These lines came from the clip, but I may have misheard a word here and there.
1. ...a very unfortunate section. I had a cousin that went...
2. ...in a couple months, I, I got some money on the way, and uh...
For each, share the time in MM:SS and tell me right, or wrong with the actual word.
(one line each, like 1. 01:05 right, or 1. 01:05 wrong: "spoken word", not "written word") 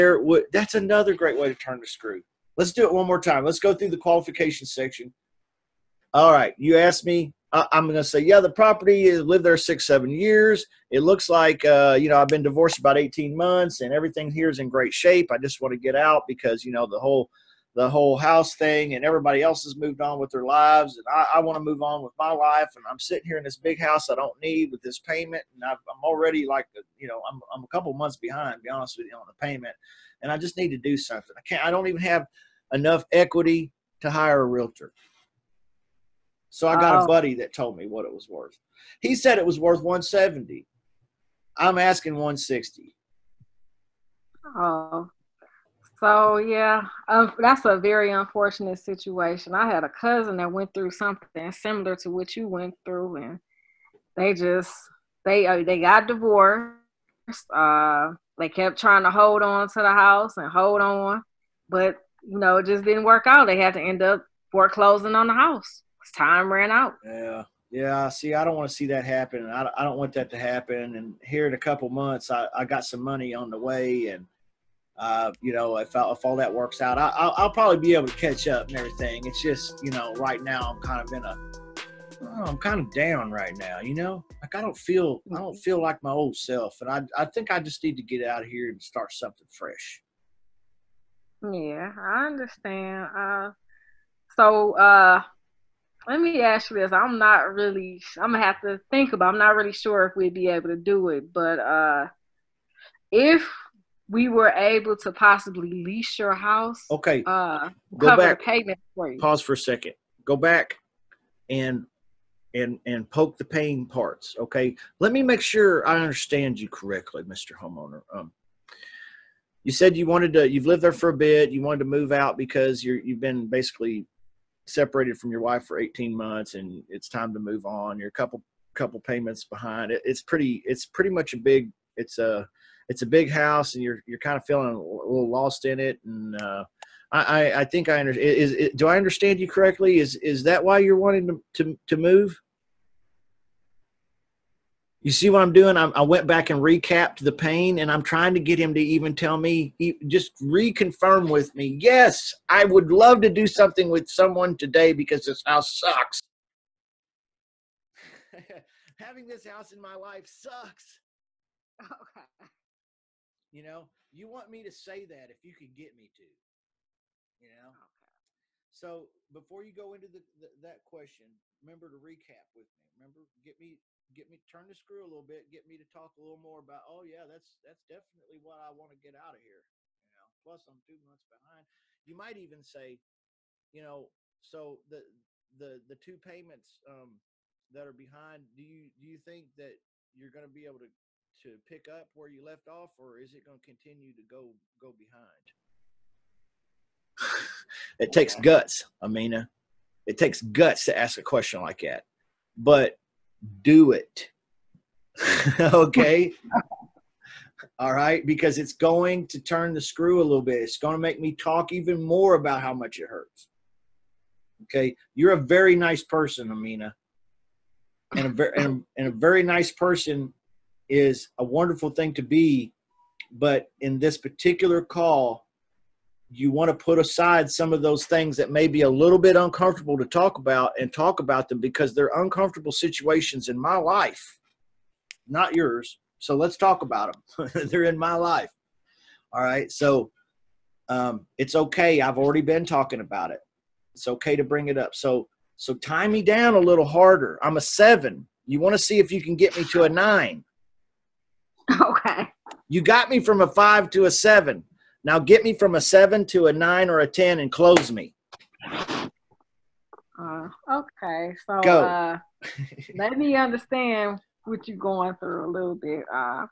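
1. 00:47 wrong: "situation", not "section"
2. 01:11 right.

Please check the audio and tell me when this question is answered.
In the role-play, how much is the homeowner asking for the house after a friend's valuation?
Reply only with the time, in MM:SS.
00:41.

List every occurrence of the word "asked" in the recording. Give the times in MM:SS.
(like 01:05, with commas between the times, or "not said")
00:06.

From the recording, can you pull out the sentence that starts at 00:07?
I'm going to say, yeah, the property is lived there six, seven years.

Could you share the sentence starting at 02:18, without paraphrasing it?
Is, is, do I understand you correctly?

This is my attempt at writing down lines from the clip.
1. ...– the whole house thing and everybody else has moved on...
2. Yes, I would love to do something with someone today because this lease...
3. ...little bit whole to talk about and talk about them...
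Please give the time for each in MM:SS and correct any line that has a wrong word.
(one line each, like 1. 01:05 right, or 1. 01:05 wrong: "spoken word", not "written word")
1. 00:17 right
2. 02:31 wrong: "house", not "lease"
3. 03:48 wrong: "uncomfortable", not "whole".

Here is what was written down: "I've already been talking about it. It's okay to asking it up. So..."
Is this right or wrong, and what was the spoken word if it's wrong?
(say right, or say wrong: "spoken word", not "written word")
wrong: "bring", not "asking".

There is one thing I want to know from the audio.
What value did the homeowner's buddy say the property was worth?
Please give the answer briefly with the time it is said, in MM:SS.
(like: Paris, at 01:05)
170, at 00:39.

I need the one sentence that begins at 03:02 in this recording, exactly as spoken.
You might even say, you know, so the the the two payments um, that are behind.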